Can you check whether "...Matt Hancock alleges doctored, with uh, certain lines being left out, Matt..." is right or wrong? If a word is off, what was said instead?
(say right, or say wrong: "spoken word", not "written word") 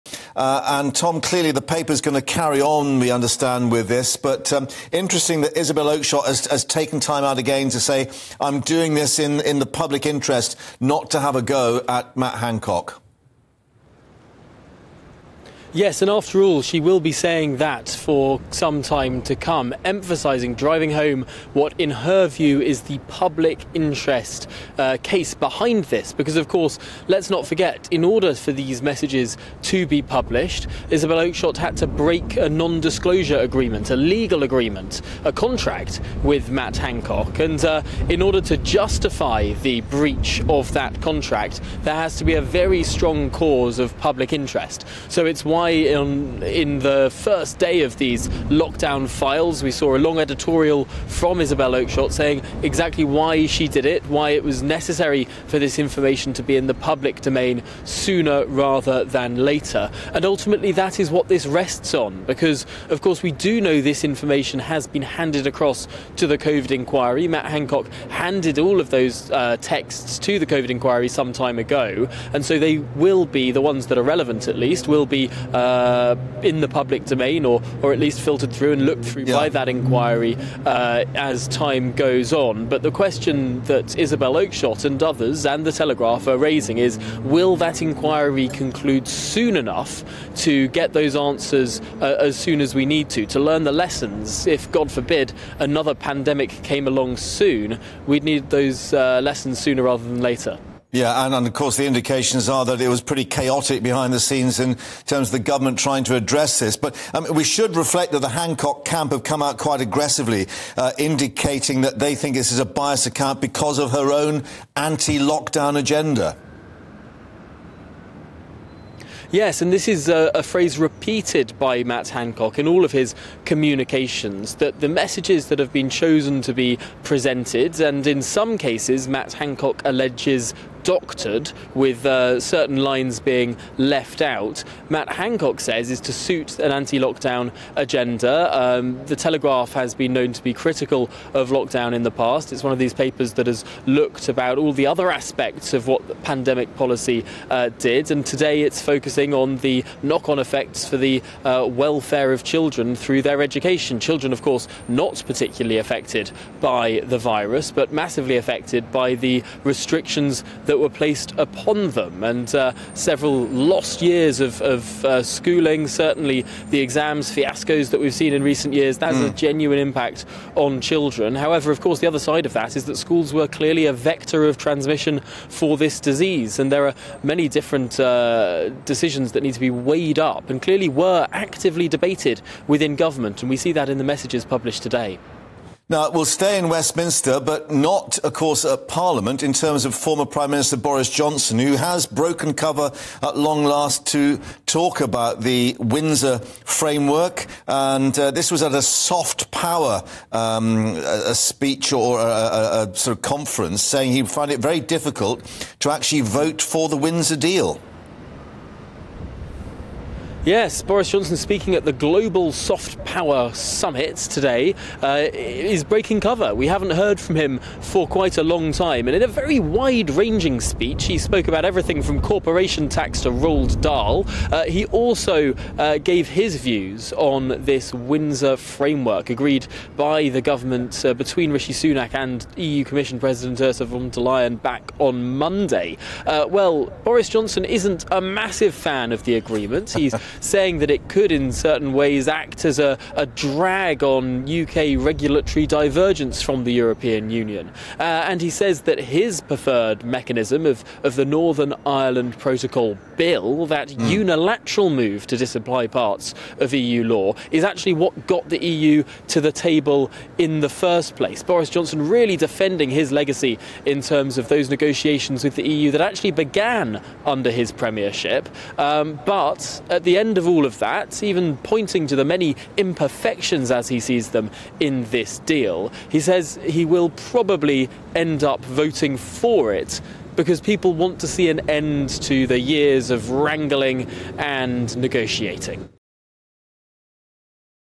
right.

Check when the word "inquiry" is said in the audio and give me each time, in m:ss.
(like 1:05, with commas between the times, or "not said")
1:06, 1:10, 1:19, 1:27.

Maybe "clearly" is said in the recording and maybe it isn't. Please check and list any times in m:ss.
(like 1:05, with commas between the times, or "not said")
0:01, 2:53, 3:00.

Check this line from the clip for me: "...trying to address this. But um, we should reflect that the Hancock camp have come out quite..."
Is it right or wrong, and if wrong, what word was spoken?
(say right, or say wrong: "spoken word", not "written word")
right.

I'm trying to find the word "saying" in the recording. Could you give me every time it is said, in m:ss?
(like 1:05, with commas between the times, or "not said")
0:17, 0:52, 3:23, 4:00.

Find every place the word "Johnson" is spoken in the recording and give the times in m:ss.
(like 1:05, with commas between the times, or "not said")
3:11, 3:31, 3:57, 4:21.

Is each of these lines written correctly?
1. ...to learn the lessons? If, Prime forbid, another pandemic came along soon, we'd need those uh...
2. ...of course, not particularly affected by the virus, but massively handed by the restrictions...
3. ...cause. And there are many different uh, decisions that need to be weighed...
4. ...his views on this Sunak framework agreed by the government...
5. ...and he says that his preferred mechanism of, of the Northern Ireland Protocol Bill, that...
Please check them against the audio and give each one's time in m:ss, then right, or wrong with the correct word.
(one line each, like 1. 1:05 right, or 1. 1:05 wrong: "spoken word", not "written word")
1. 1:33 wrong: "God", not "Prime"
2. 2:34 wrong: "affected", not "handed"
3. 2:55 wrong: "disease", not "cause"
4. 3:46 wrong: "Windsor", not "Sunak"
5. 4:08 right.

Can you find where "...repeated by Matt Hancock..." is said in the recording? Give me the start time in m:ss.
2:00.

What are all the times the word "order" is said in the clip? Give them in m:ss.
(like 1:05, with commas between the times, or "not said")
0:28, 0:38.